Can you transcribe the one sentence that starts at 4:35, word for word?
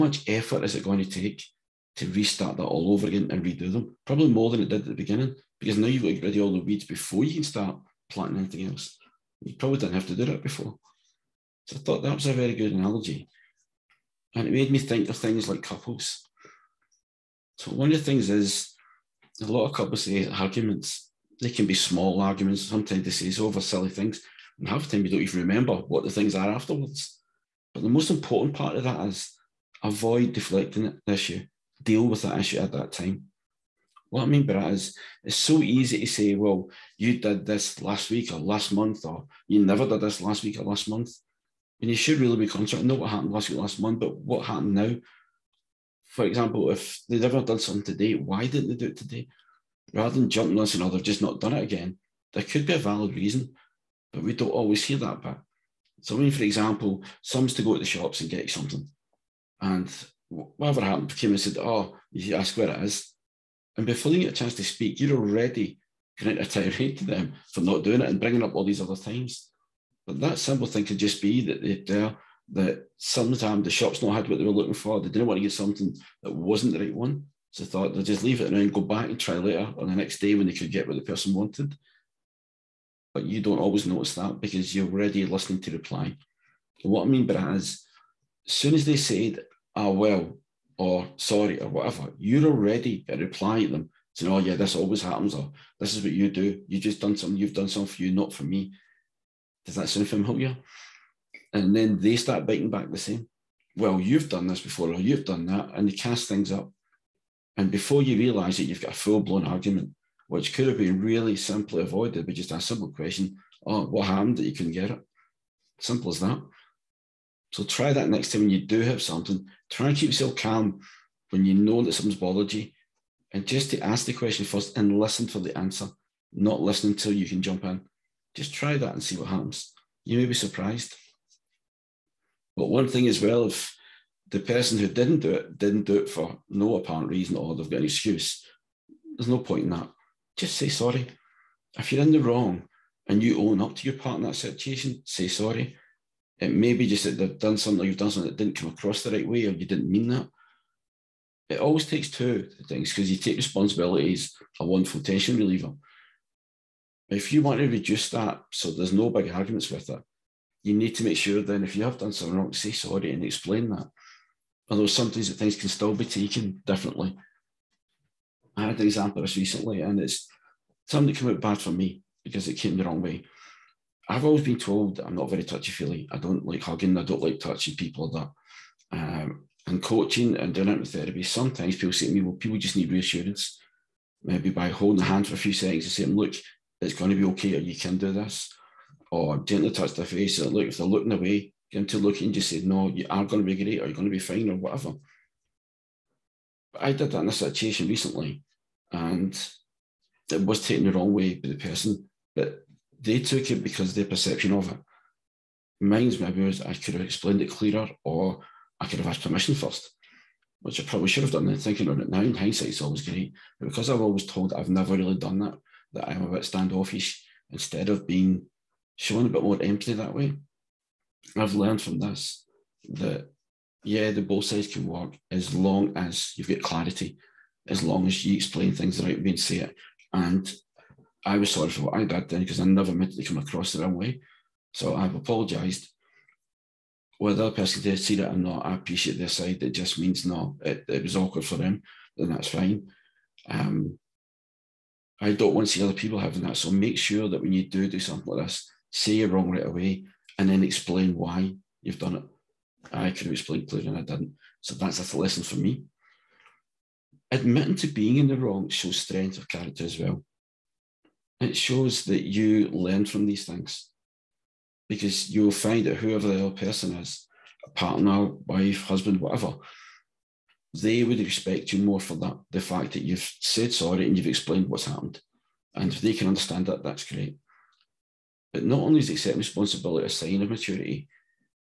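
And if they can understand that, that's great.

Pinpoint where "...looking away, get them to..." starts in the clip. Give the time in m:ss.
3:10.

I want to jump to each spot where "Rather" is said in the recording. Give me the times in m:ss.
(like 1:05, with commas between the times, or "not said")
0:49.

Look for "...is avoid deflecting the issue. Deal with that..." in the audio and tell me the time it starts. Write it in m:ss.
0:29.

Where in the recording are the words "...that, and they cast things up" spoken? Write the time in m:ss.
1:45.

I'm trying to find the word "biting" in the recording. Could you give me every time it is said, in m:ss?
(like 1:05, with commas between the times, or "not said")
1:42.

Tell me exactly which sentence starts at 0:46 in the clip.
For example, if they'd ever done something today, why didn't they do it today?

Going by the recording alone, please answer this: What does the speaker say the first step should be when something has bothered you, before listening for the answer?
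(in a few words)
Ask the question.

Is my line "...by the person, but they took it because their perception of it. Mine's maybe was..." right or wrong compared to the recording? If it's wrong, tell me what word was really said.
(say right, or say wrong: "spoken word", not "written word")
right.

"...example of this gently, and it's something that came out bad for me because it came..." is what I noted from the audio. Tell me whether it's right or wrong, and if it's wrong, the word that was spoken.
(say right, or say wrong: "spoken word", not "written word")
wrong: "recently", not "gently".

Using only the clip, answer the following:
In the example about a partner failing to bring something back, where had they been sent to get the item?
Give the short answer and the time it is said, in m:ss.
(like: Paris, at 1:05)
The shops, at 0:57.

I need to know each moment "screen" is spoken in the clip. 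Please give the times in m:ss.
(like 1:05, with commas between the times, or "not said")
not said.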